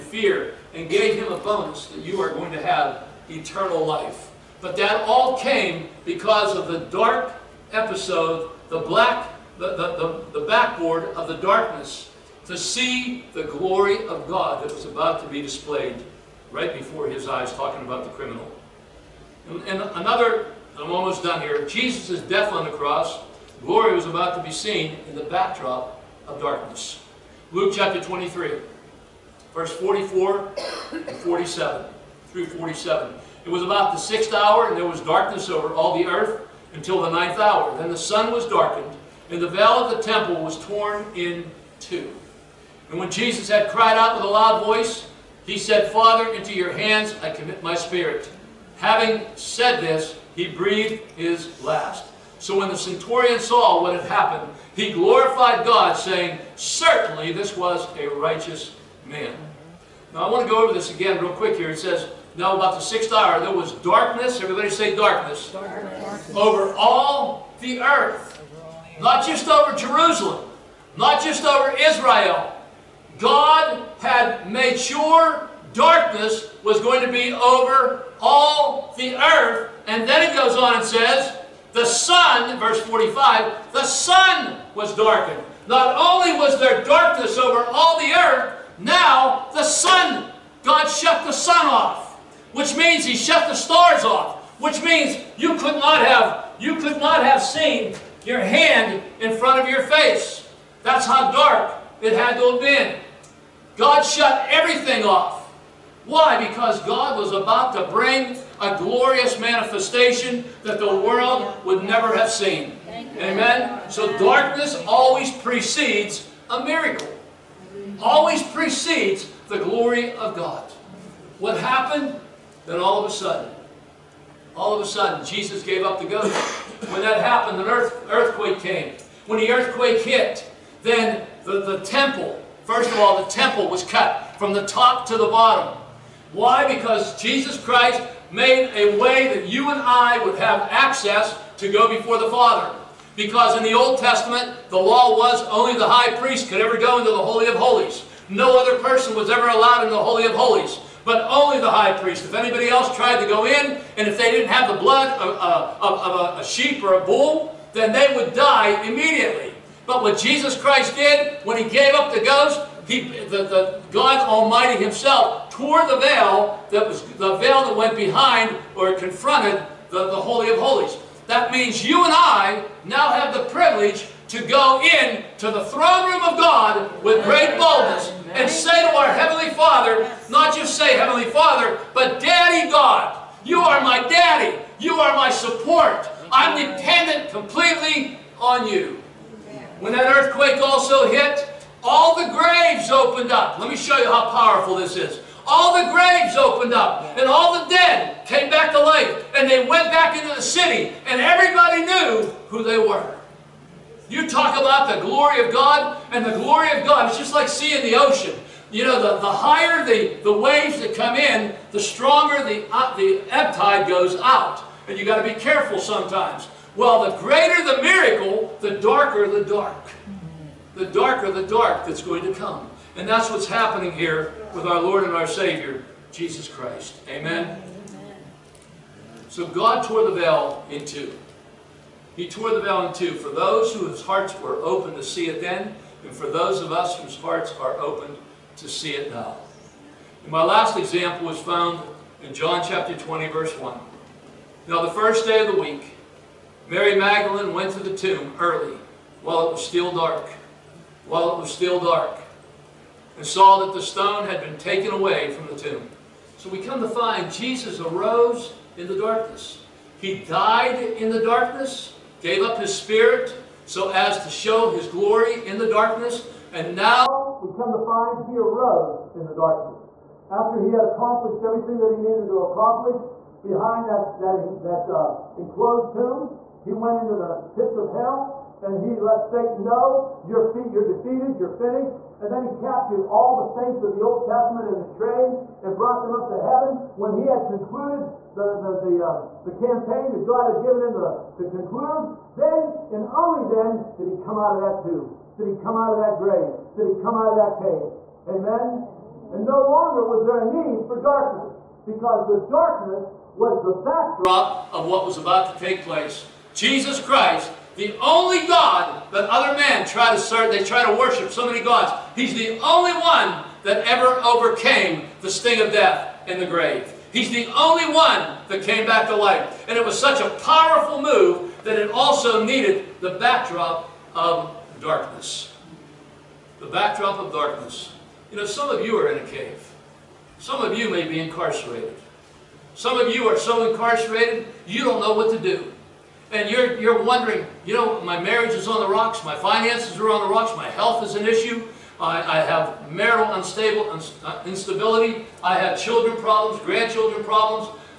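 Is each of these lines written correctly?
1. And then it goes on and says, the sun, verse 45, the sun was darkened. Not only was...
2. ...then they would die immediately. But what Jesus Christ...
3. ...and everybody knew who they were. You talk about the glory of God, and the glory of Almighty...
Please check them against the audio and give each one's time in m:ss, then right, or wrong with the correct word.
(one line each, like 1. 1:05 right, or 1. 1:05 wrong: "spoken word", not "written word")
1. 1:19 right
2. 2:37 right
3. 3:21 wrong: "God", not "Almighty".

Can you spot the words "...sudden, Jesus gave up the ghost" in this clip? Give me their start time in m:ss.
2:04.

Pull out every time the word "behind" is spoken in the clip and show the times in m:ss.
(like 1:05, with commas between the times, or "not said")
2:47, 4:33.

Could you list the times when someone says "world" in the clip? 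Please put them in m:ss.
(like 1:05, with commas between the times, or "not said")
1:50.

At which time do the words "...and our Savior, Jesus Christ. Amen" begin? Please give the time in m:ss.
3:45.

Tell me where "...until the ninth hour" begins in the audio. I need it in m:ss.
0:36.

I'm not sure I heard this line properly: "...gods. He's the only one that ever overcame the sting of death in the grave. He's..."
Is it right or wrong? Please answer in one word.
right.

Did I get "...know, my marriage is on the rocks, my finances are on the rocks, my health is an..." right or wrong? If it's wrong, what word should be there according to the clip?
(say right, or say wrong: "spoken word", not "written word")
right.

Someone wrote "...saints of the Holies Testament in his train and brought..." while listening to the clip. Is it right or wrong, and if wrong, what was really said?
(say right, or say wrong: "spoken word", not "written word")
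wrong: "Old", not "Holies".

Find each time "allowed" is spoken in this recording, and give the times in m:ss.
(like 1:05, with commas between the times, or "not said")
2:29.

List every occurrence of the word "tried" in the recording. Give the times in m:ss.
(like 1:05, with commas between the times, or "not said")
2:32.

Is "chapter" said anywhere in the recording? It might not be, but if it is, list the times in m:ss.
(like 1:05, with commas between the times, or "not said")
0:27, 4:02.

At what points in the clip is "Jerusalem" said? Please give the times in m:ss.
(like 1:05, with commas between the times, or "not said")
1:09.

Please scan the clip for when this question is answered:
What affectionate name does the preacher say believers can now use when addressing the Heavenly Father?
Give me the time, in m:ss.
3:02.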